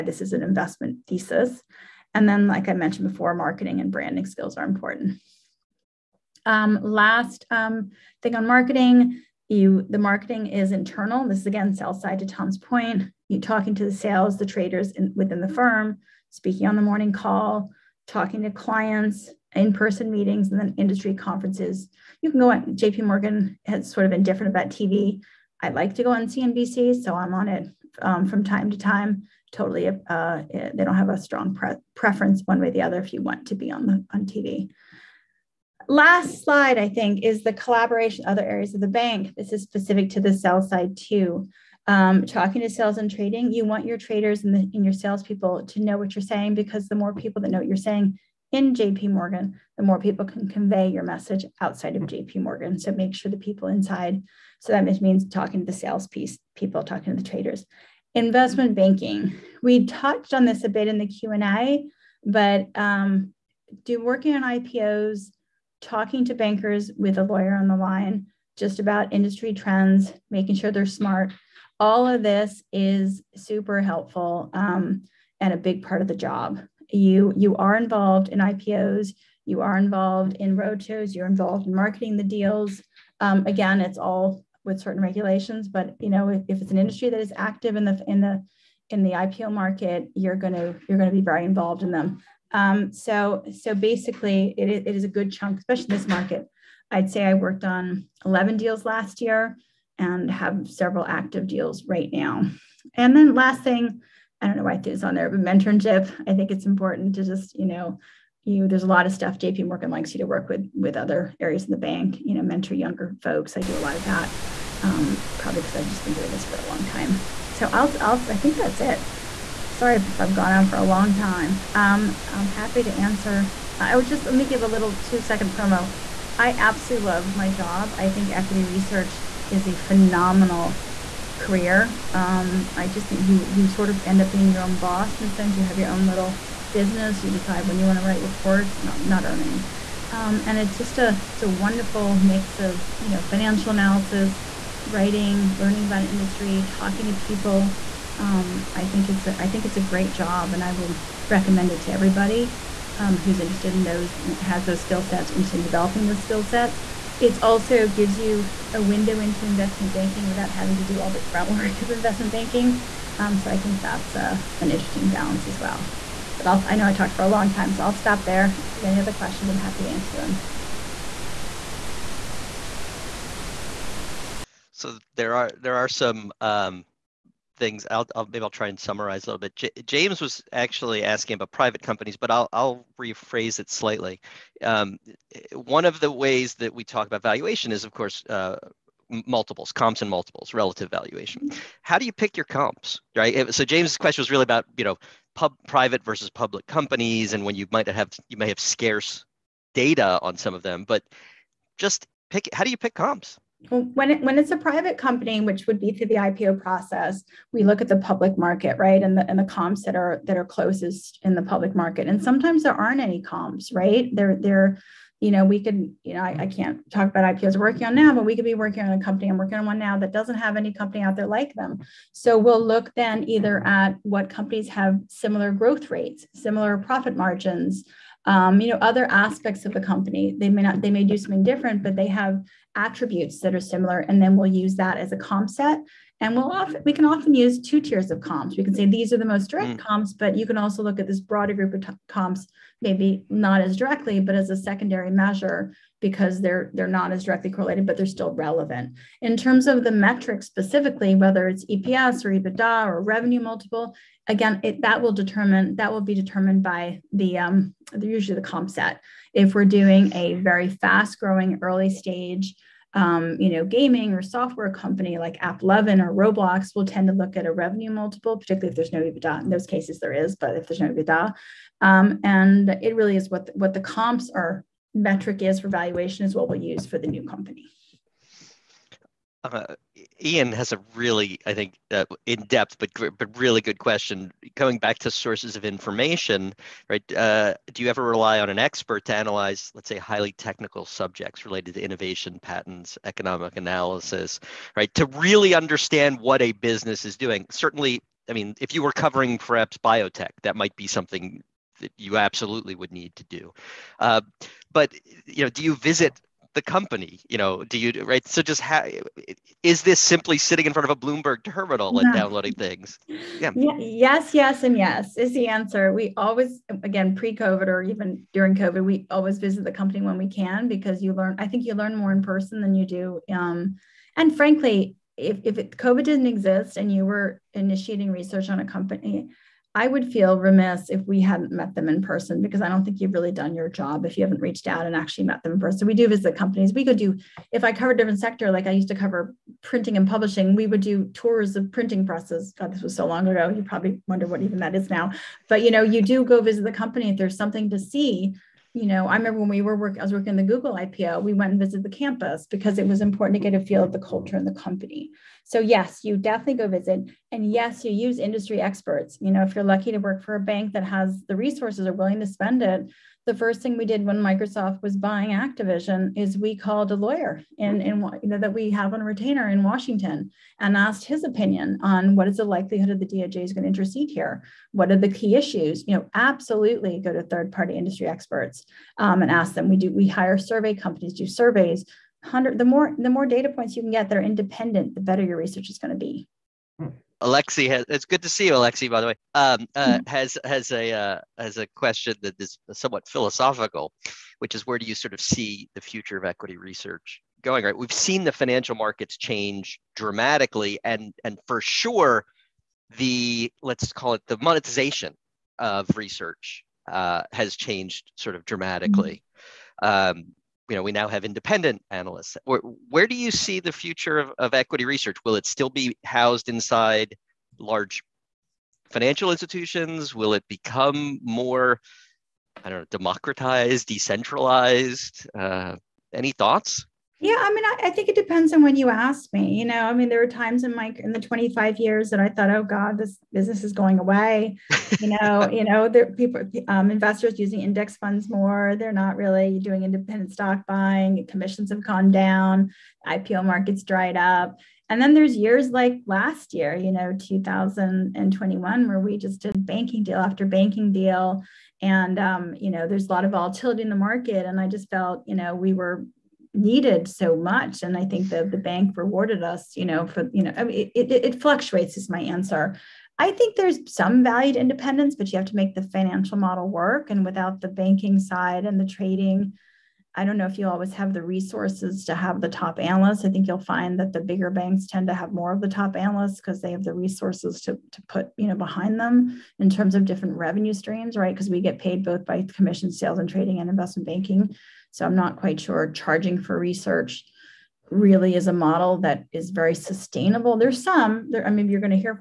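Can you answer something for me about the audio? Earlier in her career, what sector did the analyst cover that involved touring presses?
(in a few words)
printing and publishing.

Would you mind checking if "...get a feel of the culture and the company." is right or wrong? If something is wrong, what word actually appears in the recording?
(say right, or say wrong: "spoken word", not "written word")
right.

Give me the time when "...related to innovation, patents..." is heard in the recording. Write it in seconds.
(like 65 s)
291 s.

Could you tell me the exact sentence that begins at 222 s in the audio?
So we'll look then either at what companies have similar growth rates, similar profit margins.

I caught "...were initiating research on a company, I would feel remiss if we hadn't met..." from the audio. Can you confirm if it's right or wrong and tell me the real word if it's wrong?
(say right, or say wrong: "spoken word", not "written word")
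right.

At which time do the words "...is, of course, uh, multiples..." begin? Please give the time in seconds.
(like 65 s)
187 s.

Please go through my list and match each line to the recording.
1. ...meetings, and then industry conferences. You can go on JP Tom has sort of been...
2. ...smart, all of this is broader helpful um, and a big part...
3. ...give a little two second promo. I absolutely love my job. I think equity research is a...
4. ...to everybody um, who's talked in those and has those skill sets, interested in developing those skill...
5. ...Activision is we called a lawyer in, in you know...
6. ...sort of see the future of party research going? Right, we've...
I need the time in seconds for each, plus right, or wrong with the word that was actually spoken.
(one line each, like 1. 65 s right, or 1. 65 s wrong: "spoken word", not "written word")
1. 20 s wrong: "Morgan", not "Tom"
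2. 70 s wrong: "super", not "broader"
3. 124 s right
4. 151 s wrong: "interested", not "talked"
5. 365 s right
6. 394 s wrong: "equity", not "party".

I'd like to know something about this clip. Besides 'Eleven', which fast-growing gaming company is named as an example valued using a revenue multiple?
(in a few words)
Roblox.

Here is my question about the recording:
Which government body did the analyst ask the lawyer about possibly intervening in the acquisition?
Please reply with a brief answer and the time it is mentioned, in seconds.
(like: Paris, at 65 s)
DOJ, at 373 s.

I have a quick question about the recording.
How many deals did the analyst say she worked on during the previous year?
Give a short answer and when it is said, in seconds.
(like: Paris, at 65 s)
11, at 98 s.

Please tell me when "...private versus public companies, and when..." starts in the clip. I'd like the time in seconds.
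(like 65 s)
195 s.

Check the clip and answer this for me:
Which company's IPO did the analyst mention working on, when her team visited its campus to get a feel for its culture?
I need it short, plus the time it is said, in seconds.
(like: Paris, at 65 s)
Google, at 350 s.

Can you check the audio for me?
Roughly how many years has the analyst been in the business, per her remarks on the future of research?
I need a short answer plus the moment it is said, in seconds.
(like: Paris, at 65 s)
25, at 431 s.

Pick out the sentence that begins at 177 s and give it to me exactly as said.
I'll, I'll maybe I'll try and summarize a little bit.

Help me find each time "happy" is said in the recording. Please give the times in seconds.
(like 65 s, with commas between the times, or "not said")
122 s, 169 s.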